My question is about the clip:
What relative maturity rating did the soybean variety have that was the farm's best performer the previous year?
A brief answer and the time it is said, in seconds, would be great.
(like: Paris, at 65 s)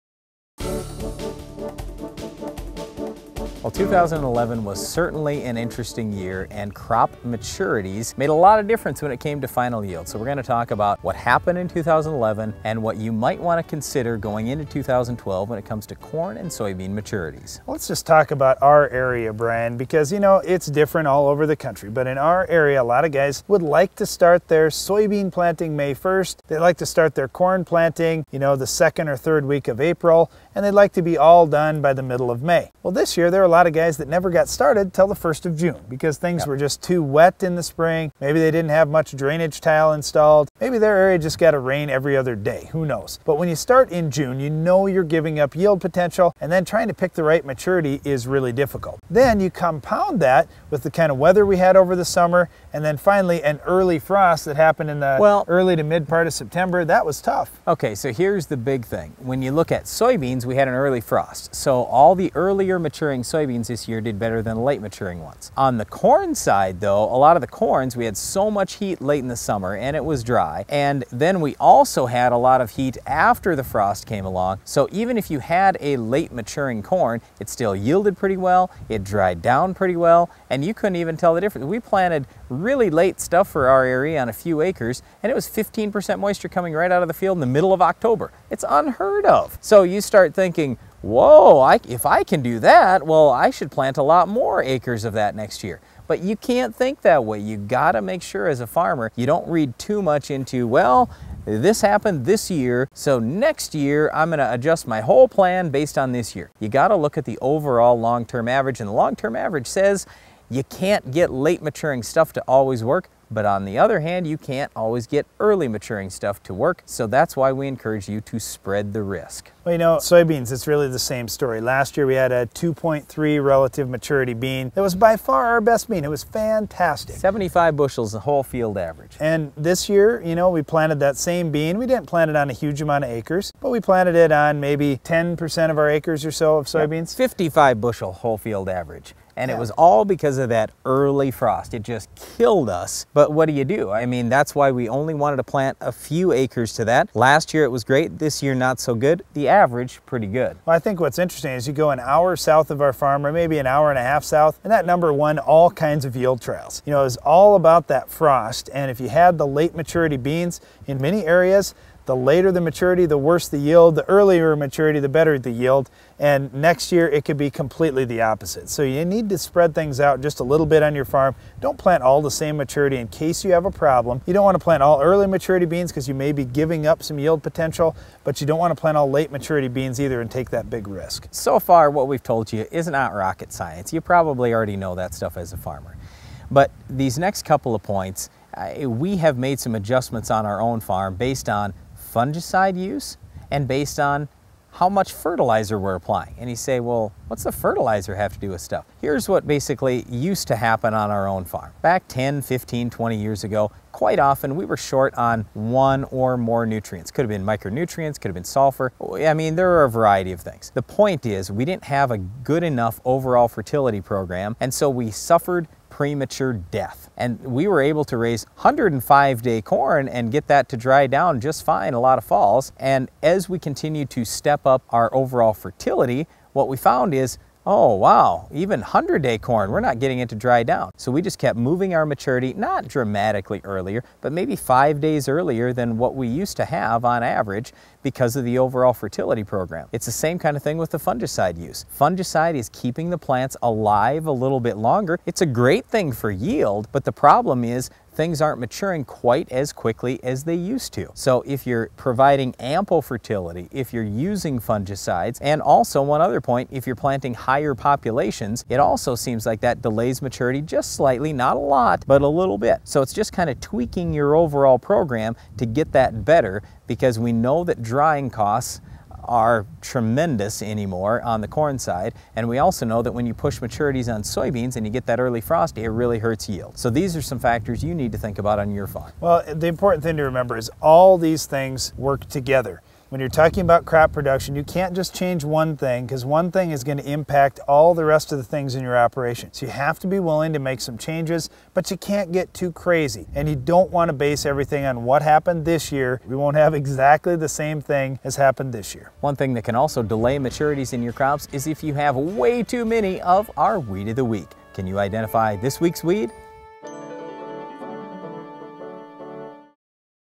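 2.3, at 122 s.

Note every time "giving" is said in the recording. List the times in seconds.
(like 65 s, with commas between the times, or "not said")
45 s, 176 s.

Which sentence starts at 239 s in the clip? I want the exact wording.
It's the same kind of thing with the fungicide use.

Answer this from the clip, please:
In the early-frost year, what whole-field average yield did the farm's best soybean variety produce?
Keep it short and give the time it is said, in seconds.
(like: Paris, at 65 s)
55 bushels, at 137 s.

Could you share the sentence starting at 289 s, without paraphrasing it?
So you have to be willing to make some changes, but you can't get too crazy.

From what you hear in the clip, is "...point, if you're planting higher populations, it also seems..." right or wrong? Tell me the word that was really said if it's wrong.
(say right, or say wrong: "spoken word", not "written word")
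right.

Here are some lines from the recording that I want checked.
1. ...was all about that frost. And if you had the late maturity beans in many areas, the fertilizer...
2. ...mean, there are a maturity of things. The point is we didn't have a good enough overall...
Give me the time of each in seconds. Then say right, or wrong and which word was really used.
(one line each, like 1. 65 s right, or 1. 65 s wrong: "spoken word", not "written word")
1. 157 s wrong: "later", not "fertilizer"
2. 209 s wrong: "variety", not "maturity".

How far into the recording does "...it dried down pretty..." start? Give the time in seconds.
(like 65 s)
78 s.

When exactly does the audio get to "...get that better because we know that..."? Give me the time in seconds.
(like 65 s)
265 s.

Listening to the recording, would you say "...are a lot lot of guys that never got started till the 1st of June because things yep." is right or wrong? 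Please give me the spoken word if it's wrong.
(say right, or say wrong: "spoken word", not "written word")
right.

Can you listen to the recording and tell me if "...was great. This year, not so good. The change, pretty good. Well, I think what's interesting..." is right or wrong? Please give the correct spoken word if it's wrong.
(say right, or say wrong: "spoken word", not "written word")
wrong: "average", not "change".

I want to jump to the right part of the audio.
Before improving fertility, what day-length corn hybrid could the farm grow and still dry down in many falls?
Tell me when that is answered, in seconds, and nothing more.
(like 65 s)
218 s.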